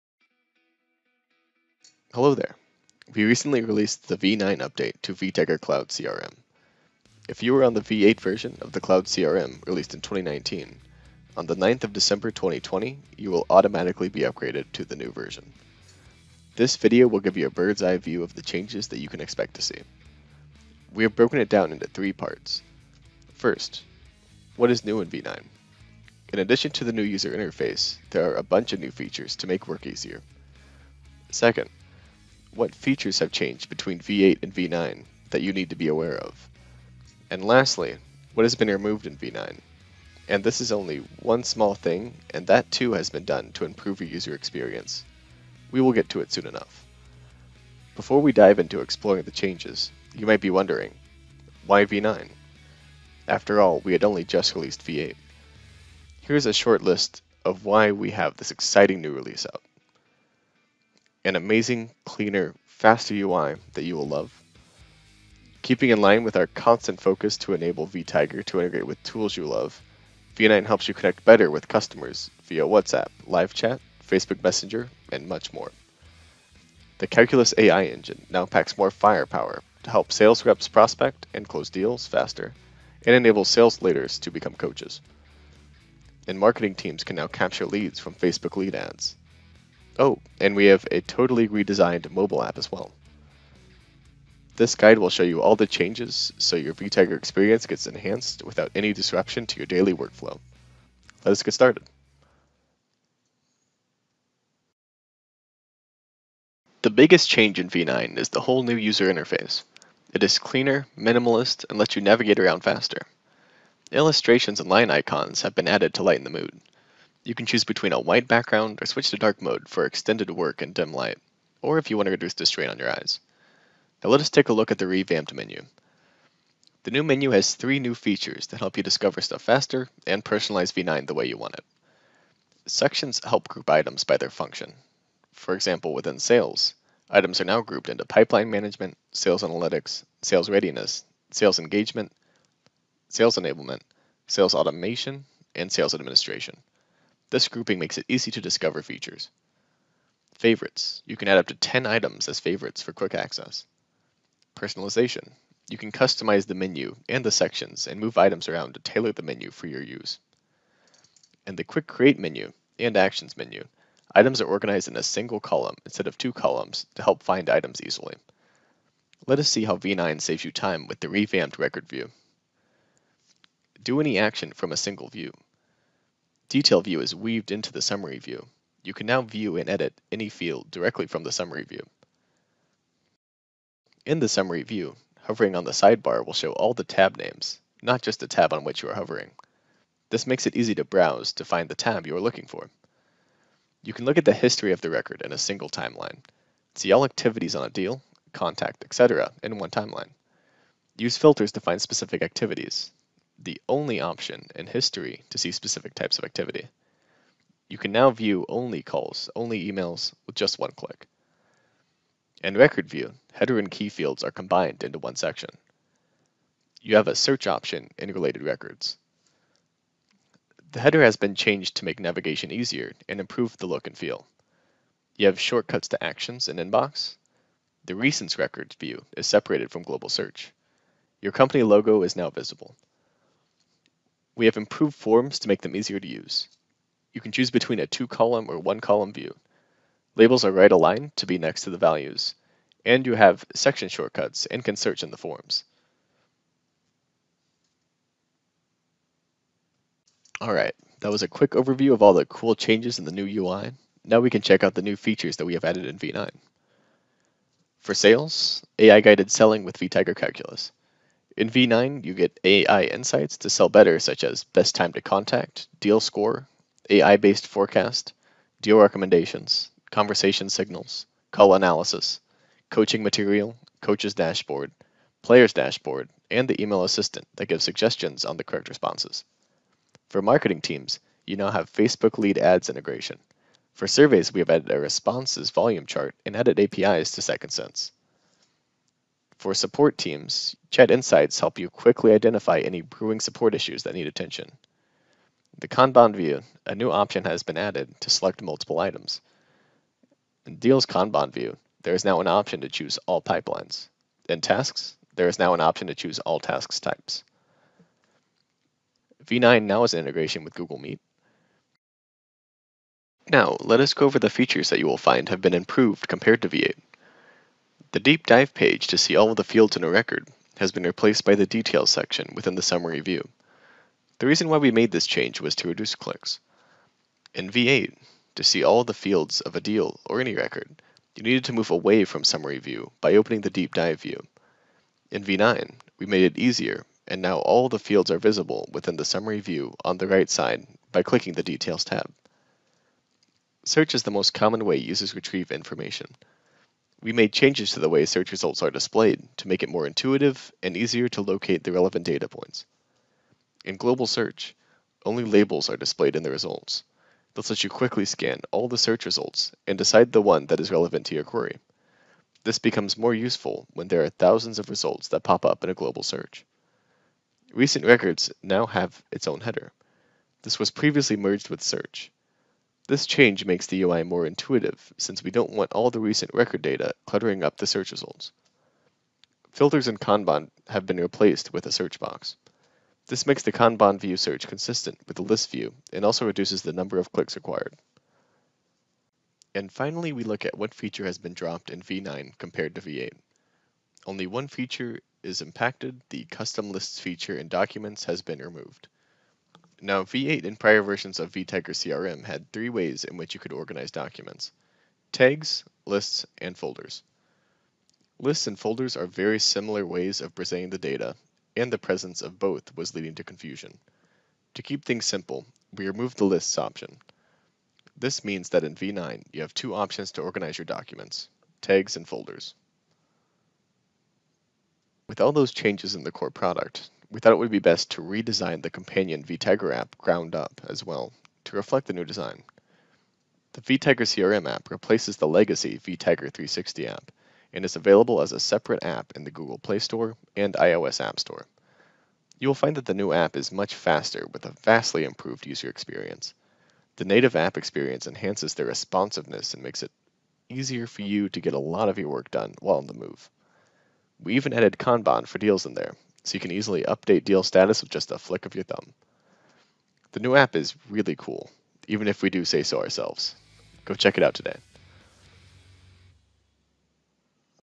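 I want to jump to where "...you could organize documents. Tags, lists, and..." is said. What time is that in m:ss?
6:43.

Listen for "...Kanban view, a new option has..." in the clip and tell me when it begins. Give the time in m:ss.
4:55.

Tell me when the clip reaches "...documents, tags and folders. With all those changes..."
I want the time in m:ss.
7:00.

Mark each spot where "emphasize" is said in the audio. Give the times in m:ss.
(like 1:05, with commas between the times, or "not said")
not said.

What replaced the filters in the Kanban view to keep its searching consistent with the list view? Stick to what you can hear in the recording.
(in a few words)
A search box.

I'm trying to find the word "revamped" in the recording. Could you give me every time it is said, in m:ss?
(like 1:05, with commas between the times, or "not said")
2:04, 2:51.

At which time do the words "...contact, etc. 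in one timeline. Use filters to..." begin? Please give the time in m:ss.
3:18.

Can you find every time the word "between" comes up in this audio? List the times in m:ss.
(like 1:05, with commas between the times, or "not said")
0:33, 1:57, 3:57.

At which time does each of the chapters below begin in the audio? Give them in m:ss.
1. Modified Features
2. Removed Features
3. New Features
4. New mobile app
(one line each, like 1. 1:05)
1. 5:12
2. 6:30
3. 1:44
4. 7:05.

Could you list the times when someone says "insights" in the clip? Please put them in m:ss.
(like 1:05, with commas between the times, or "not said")
4:22, 4:50.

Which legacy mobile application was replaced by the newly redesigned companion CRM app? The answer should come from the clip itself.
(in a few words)
vTiger 360.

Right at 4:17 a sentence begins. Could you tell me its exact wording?
For sales, AI-guided selling with VTiger Calculus.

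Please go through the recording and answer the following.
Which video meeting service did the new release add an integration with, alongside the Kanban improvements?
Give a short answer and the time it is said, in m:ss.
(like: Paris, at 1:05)
Google Meet, at 5:10.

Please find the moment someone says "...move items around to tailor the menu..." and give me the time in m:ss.
2:38.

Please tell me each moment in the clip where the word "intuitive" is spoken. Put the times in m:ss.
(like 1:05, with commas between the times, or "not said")
5:49, 6:14.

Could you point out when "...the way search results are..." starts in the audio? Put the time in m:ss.
5:47.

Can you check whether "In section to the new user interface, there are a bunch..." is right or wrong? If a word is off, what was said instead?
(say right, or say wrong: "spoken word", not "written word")
wrong: "addition", not "section".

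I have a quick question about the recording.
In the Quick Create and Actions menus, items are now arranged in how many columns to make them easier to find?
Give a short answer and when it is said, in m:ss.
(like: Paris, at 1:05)
1, at 2:45.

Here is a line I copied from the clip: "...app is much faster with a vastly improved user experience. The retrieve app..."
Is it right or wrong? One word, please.
wrong.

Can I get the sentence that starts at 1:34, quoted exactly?
This guide will show you all the changes so your VTiger experience gets enhanced without any disruption to your daily workflow.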